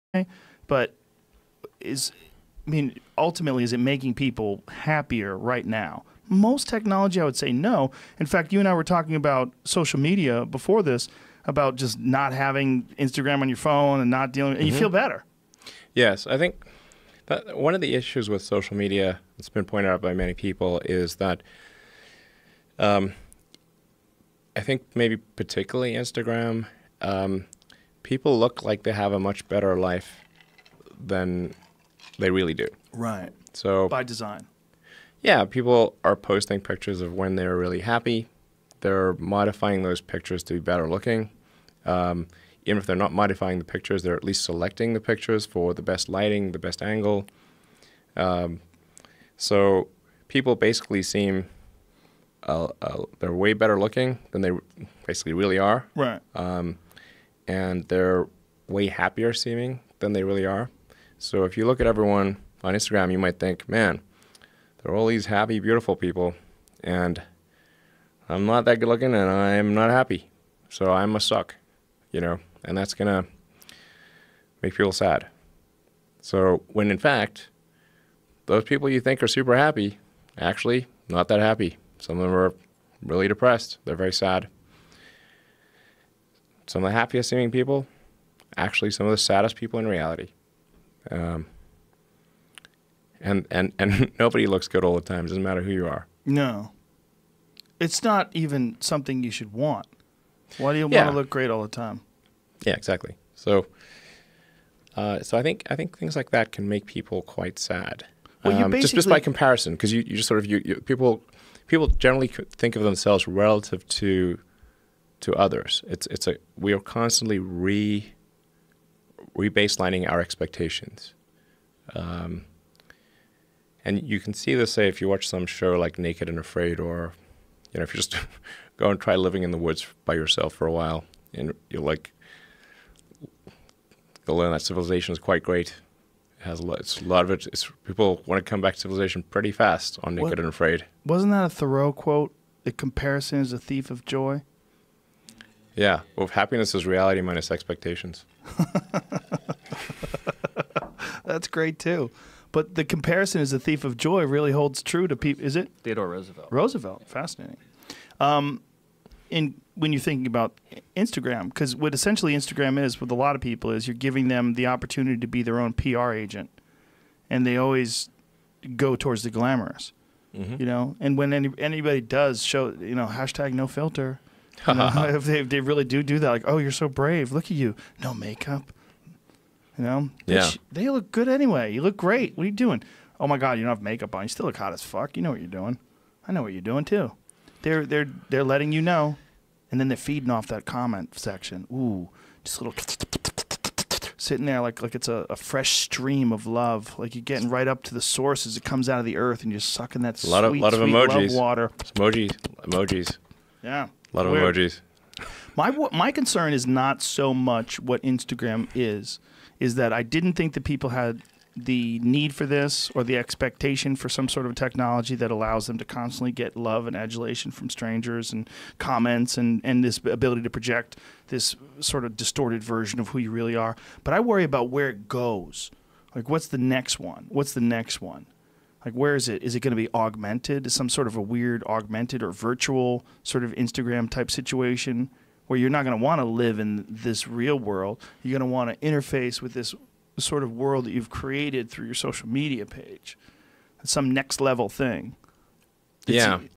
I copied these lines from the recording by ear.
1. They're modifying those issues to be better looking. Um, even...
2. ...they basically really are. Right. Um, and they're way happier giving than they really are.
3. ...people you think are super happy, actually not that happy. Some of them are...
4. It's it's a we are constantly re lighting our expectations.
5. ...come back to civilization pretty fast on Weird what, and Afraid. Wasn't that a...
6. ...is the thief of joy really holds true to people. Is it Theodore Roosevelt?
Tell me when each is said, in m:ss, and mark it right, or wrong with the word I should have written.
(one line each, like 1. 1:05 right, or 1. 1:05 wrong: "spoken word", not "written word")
1. 0:38 wrong: "pictures", not "issues"
2. 0:54 wrong: "seeming", not "giving"
3. 1:18 right
4. 1:55 wrong: "baselining", not "lighting"
5. 2:18 wrong: "Naked", not "Weird"
6. 2:33 right.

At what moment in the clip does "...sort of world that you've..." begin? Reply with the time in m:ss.
4:00.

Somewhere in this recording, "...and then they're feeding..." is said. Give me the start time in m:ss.
3:09.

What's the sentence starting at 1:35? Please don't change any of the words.
It doesn't matter who you are.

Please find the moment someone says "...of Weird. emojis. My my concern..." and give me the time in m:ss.
3:24.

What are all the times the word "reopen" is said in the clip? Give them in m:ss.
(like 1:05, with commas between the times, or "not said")
not said.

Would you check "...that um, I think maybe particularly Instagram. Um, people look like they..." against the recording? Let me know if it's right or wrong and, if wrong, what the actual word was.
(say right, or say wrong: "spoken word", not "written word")
right.